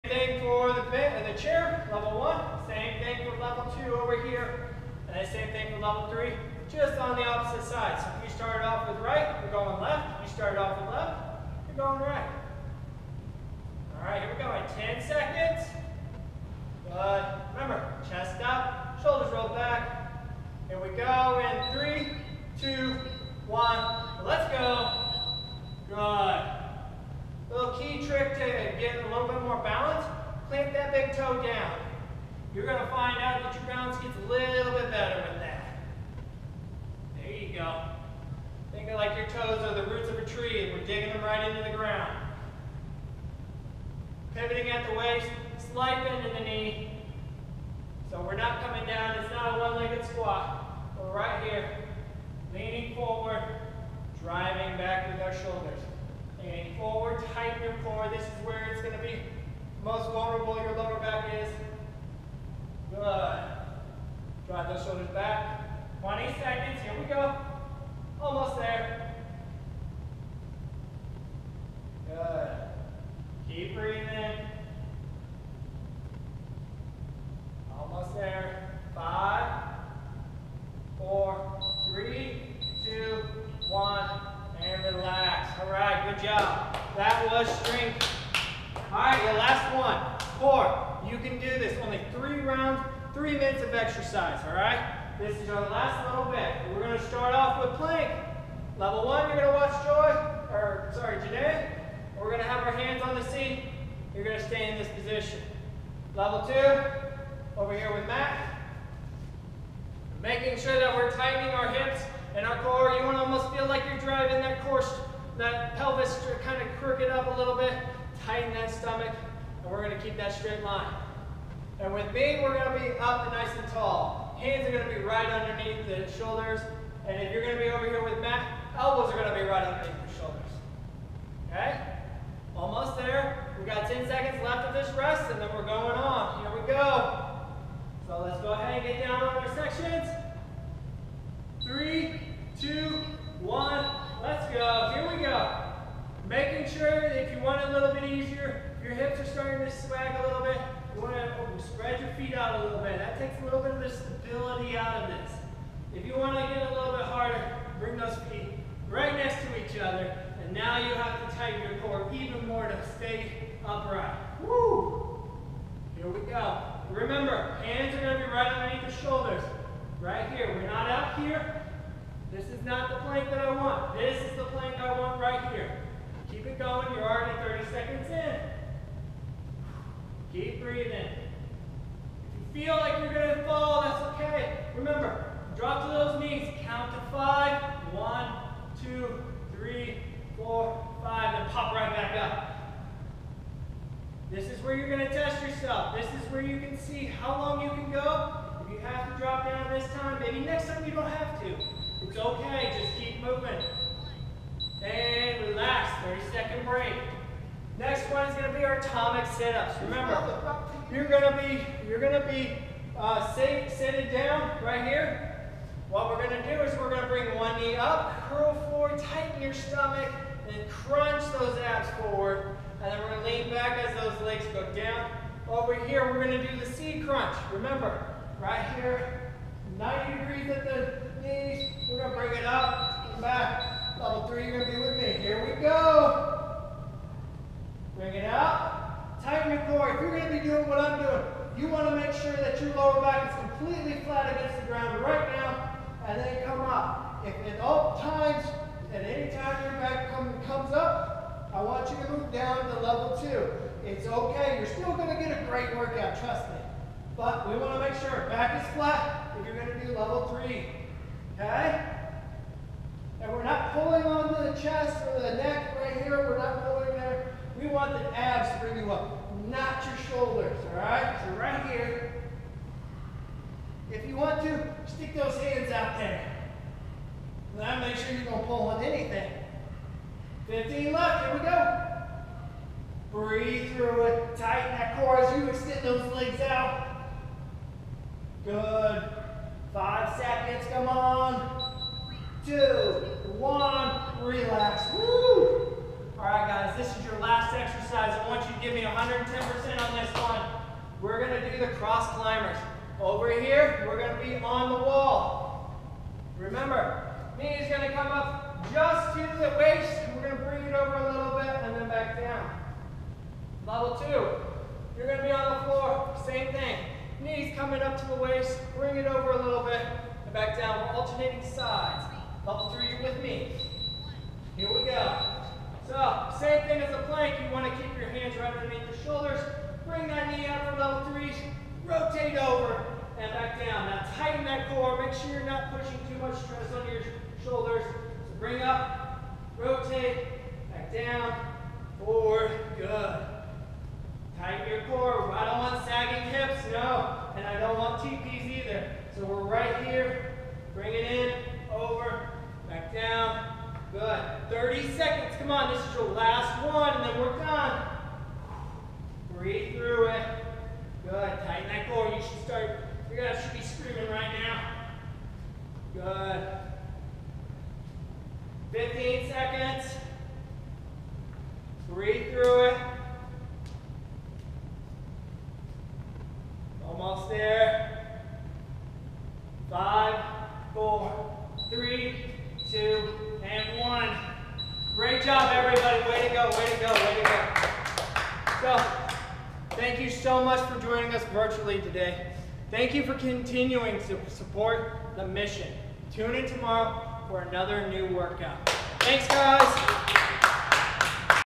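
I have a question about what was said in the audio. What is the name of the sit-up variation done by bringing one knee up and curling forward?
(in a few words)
Atomic sit-ups.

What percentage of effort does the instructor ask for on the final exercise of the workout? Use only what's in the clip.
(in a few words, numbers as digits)
110%.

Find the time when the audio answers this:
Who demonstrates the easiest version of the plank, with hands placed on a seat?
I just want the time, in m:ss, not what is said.
1:41.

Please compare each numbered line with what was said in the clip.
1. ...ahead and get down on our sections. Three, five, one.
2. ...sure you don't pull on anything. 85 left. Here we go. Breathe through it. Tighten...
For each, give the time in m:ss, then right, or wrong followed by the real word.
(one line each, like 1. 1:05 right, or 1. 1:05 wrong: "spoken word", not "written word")
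1. 2:18 wrong: "two", not "five"
2. 4:37 wrong: "15", not "85".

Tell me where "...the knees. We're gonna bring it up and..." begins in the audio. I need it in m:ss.
3:50.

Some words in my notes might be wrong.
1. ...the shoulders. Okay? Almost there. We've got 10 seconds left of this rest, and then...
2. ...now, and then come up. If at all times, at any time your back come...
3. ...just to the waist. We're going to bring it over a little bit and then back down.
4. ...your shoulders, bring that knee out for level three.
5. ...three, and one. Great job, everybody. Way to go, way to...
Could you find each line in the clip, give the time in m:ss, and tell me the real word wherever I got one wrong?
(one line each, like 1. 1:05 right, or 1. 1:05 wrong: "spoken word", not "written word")
1. 2:10 right
2. 4:05 right
3. 5:08 right
4. 5:28 right
5. 6:22 wrong: "two", not "three".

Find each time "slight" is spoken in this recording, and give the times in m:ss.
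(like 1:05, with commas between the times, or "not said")
0:45.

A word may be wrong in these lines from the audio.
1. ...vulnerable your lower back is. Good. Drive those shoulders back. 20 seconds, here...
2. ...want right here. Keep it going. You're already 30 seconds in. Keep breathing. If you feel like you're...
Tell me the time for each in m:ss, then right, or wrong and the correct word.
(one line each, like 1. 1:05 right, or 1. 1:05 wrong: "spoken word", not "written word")
1. 1:00 right
2. 2:54 right.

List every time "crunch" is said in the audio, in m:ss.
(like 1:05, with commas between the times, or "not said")
3:40, 3:47.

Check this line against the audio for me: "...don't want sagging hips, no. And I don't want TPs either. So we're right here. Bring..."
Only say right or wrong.
right.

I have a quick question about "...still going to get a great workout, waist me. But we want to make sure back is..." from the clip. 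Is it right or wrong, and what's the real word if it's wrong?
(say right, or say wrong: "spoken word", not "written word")
wrong: "trust", not "waist".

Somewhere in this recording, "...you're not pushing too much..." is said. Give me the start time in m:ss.
5:35.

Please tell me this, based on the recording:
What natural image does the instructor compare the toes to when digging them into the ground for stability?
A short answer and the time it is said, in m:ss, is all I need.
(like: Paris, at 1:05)
Roots of a tree, at 0:39.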